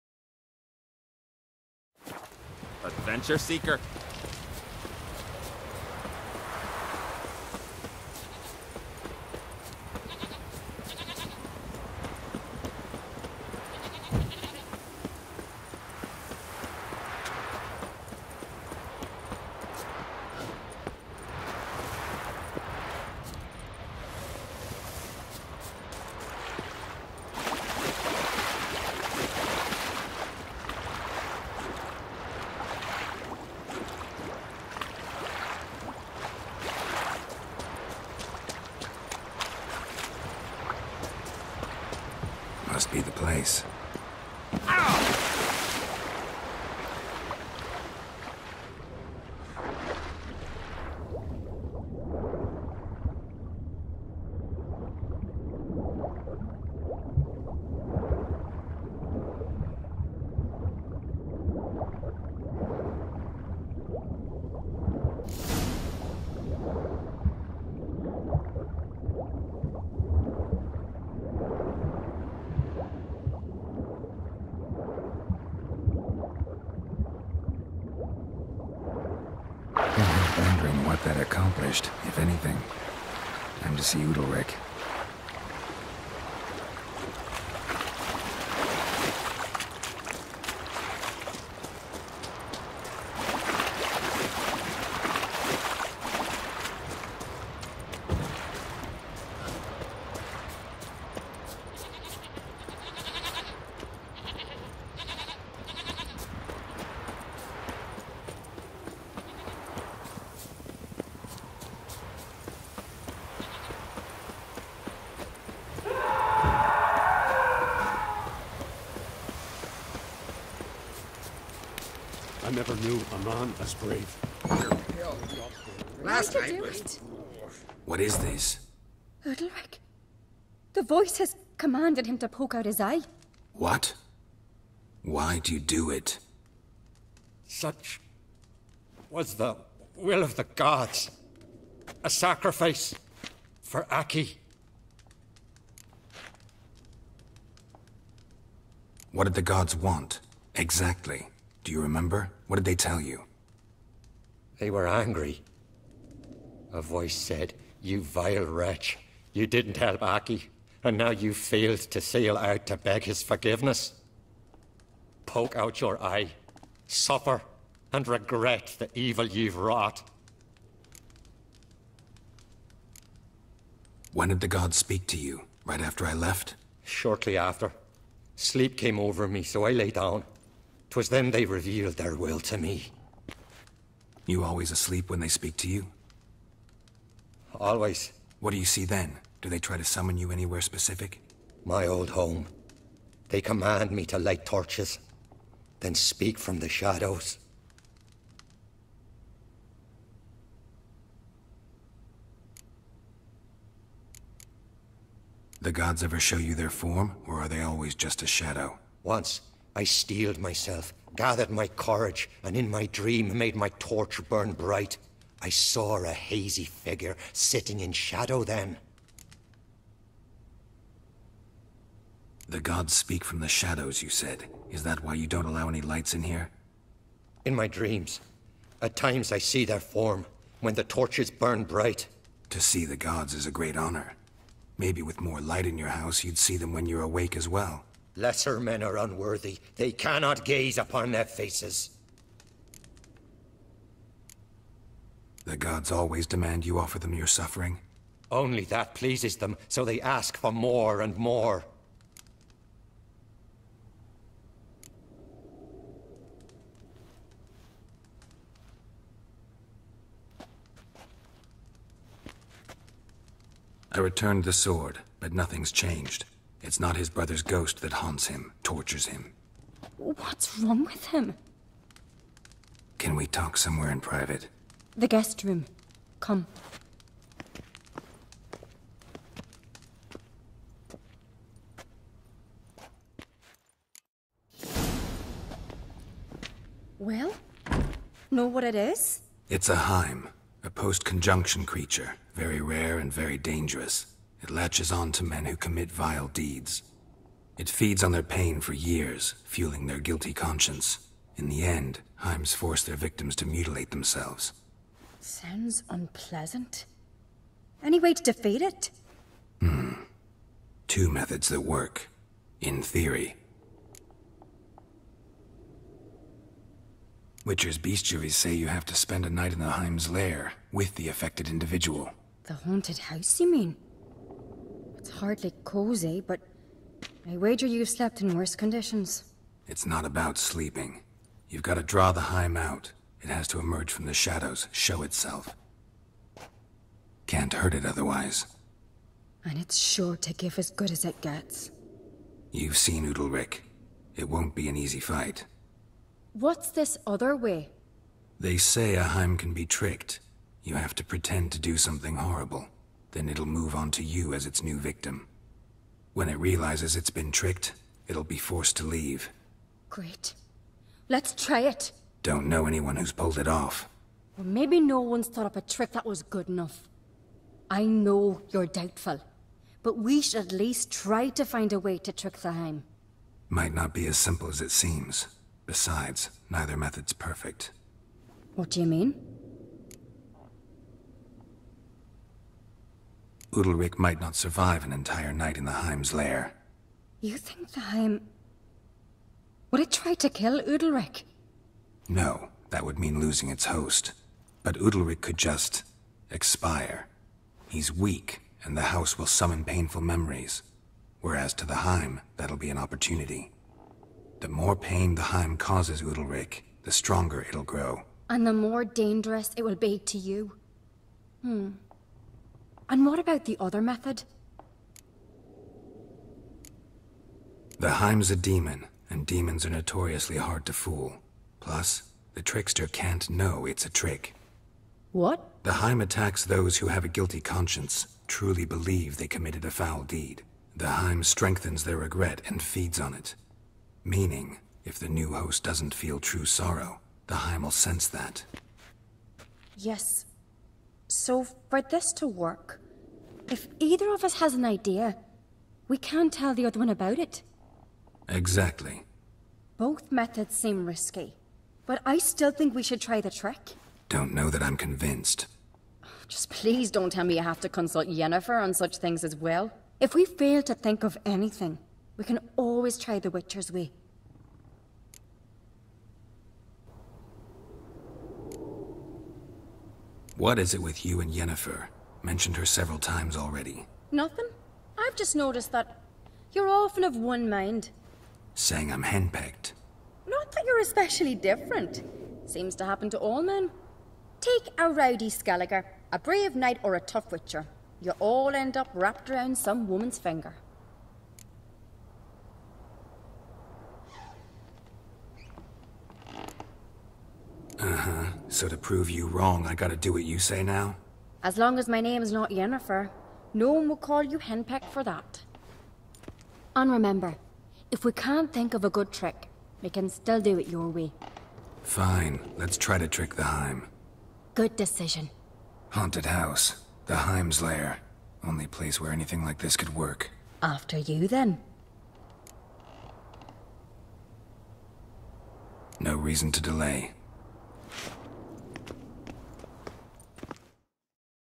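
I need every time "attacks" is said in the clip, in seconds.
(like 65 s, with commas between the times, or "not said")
426 s.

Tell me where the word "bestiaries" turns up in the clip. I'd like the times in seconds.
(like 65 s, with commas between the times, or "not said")
317 s.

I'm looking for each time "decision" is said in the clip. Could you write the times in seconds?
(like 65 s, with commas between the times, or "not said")
514 s.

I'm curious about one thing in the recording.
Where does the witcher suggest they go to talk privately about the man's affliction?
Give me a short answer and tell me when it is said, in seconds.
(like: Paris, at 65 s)
The guest room, at 274 s.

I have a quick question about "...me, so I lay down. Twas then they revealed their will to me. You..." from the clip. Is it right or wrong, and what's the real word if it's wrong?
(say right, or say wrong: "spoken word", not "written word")
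right.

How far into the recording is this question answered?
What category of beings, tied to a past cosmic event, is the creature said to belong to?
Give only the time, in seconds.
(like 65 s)
290 s.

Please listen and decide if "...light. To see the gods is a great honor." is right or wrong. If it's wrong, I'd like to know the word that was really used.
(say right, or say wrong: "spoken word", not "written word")
wrong: "bright", not "light".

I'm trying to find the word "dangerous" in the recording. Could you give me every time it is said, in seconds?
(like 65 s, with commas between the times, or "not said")
293 s, 408 s.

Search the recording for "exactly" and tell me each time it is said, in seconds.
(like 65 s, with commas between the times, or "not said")
150 s, 448 s.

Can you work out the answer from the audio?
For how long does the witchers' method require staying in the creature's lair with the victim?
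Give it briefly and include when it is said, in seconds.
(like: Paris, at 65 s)
A night, at 319 s.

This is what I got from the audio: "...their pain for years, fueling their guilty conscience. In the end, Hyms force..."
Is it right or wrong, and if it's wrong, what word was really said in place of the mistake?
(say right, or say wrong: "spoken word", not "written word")
right.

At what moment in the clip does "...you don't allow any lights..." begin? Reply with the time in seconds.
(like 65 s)
225 s.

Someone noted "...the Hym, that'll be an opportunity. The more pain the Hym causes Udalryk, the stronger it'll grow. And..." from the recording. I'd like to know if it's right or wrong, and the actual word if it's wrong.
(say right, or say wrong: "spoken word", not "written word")
right.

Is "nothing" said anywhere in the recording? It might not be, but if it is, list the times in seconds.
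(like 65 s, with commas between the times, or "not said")
265 s, 474 s.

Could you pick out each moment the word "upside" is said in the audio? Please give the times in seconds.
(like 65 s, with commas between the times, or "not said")
not said.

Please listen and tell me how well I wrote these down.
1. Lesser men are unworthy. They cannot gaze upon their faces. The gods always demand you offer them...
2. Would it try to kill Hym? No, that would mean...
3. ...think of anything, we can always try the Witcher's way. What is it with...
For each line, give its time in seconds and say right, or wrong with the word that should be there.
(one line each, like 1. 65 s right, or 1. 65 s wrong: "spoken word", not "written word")
1. 238 s right
2. 389 s wrong: "Udalryk", not "Hym"
3. 460 s right.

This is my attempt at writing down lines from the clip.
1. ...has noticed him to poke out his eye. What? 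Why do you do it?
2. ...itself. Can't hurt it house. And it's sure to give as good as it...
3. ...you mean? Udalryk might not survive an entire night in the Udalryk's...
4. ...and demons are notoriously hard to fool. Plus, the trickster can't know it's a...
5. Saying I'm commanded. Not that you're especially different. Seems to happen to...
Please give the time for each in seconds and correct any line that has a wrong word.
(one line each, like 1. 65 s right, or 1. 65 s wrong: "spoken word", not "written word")
1. 131 s wrong: "commanded", not "noticed"
2. 335 s wrong: "otherwise", not "house"
3. 378 s wrong: "Hym", not "Udalryk"
4. 419 s right
5. 478 s wrong: "henpecked", not "commanded".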